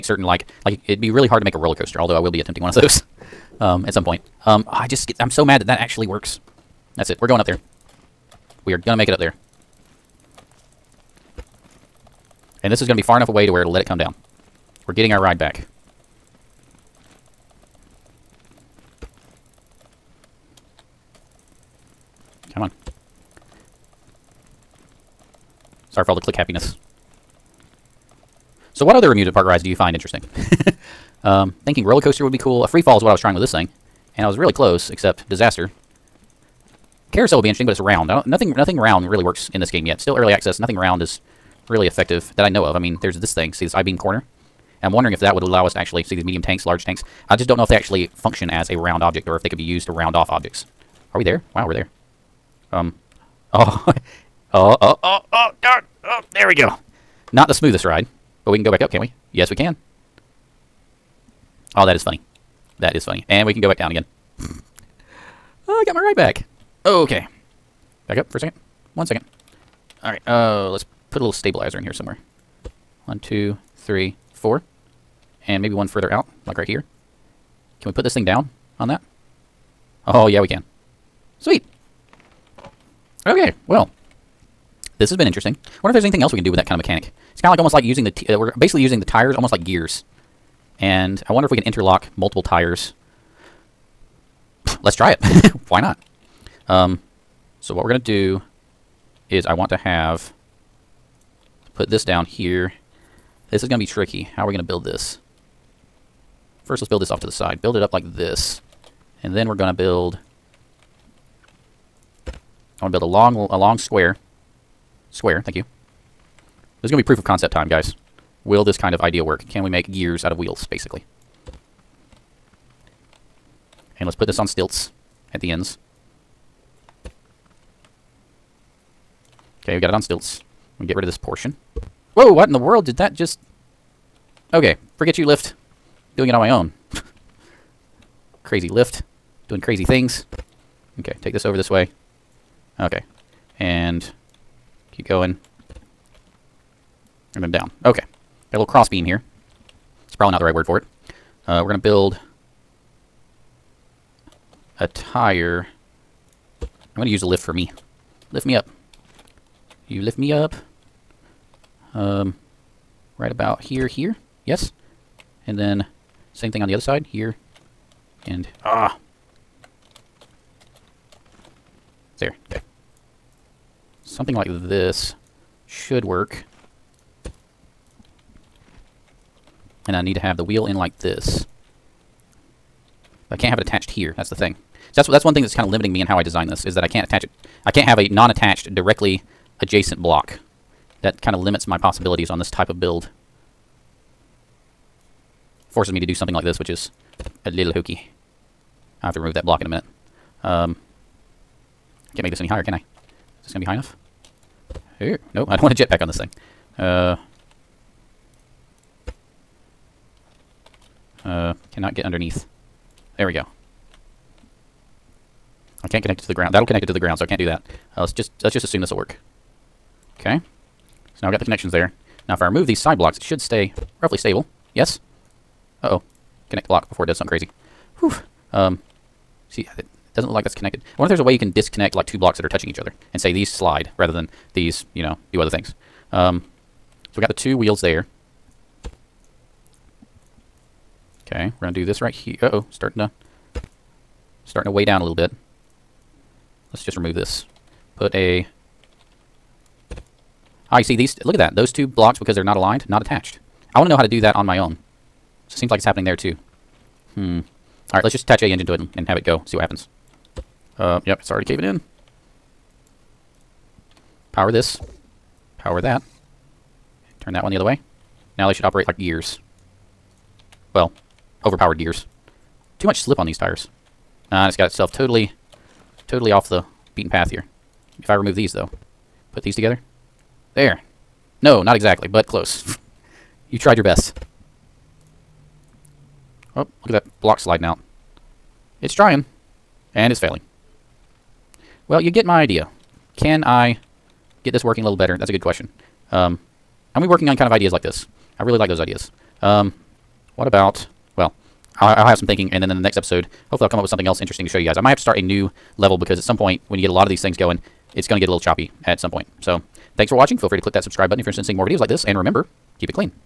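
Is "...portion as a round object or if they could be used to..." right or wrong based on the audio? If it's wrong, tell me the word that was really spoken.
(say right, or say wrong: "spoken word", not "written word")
wrong: "function", not "portion".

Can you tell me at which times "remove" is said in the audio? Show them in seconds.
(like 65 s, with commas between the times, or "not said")
199 s, 222 s, 246 s, 278 s.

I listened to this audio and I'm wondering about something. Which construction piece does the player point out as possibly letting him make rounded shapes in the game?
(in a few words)
I-beam corner.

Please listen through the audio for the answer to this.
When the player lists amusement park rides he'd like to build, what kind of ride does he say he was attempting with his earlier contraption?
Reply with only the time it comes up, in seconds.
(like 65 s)
32 s.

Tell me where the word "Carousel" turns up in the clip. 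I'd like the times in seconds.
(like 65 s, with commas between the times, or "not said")
37 s.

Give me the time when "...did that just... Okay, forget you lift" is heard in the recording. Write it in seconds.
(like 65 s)
132 s.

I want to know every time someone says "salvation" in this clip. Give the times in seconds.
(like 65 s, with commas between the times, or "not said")
not said.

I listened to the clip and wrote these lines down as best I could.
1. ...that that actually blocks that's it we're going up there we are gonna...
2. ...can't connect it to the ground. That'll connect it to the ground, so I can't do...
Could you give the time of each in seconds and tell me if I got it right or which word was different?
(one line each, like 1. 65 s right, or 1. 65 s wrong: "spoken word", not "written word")
1. 5 s wrong: "works", not "blocks"
2. 215 s right.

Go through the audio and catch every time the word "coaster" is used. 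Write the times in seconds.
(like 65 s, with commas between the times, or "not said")
1 s, 32 s.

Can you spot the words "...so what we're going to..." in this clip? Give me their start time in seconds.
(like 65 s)
97 s.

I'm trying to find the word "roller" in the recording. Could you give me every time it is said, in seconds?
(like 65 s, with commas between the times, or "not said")
1 s, 31 s.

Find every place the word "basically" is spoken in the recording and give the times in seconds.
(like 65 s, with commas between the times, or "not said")
88 s, 120 s.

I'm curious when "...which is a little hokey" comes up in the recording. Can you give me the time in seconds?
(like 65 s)
196 s.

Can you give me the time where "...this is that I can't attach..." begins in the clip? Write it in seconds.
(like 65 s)
186 s.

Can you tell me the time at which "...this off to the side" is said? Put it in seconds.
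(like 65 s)
107 s.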